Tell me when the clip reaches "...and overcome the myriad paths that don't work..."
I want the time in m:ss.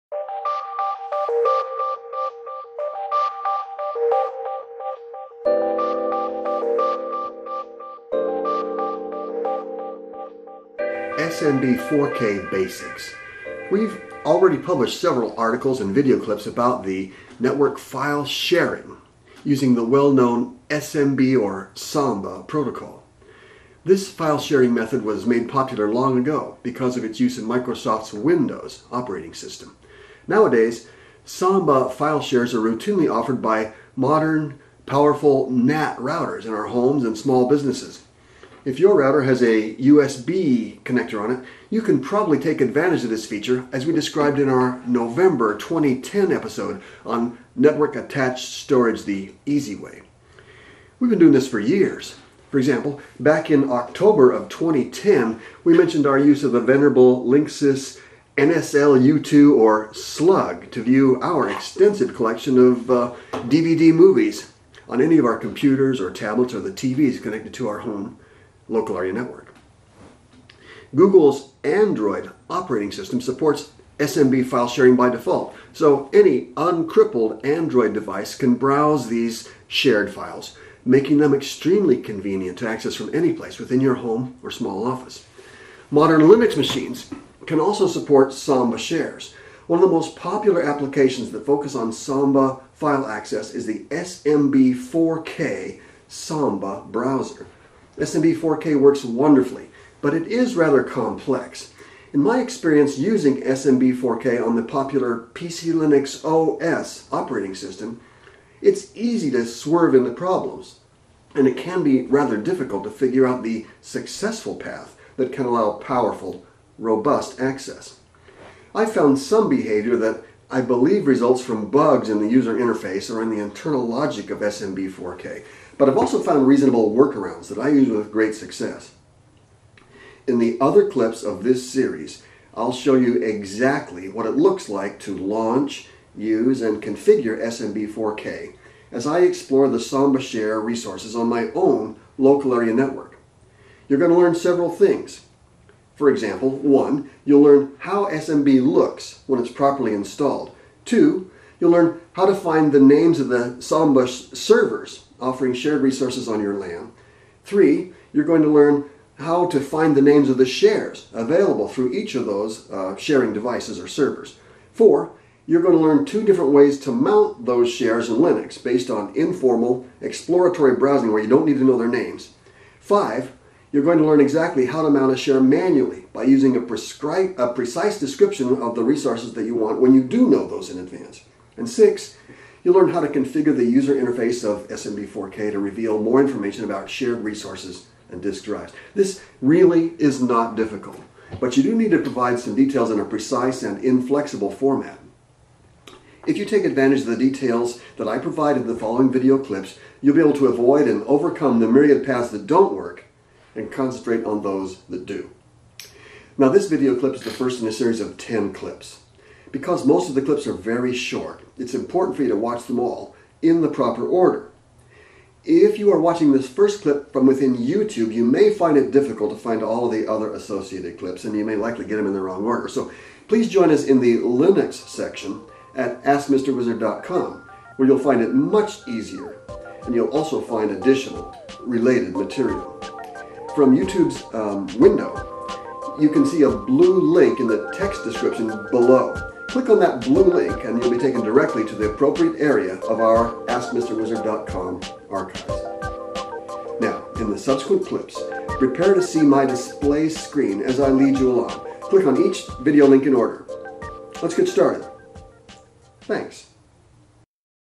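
3:20.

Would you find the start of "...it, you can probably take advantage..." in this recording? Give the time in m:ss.
0:41.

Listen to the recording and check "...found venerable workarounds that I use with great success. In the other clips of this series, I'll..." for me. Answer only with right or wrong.
wrong.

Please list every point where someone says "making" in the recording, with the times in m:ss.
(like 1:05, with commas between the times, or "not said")
1:20.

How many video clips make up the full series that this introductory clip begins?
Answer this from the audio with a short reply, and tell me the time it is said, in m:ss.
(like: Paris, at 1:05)
10, at 3:28.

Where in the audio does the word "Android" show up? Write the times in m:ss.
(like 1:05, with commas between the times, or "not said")
1:11, 1:17.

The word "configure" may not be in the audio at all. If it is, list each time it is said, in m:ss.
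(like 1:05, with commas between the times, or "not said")
2:16, 3:03.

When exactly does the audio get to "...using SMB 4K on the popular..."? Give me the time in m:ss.
1:42.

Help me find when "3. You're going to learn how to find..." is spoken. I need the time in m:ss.
2:37.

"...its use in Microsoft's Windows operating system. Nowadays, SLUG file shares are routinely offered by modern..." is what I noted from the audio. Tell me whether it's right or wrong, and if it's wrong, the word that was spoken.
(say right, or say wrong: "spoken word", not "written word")
wrong: "Samba", not "SLUG".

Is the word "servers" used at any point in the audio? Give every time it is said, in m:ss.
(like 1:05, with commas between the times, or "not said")
2:34, 2:43.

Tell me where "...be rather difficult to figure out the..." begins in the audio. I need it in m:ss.
1:51.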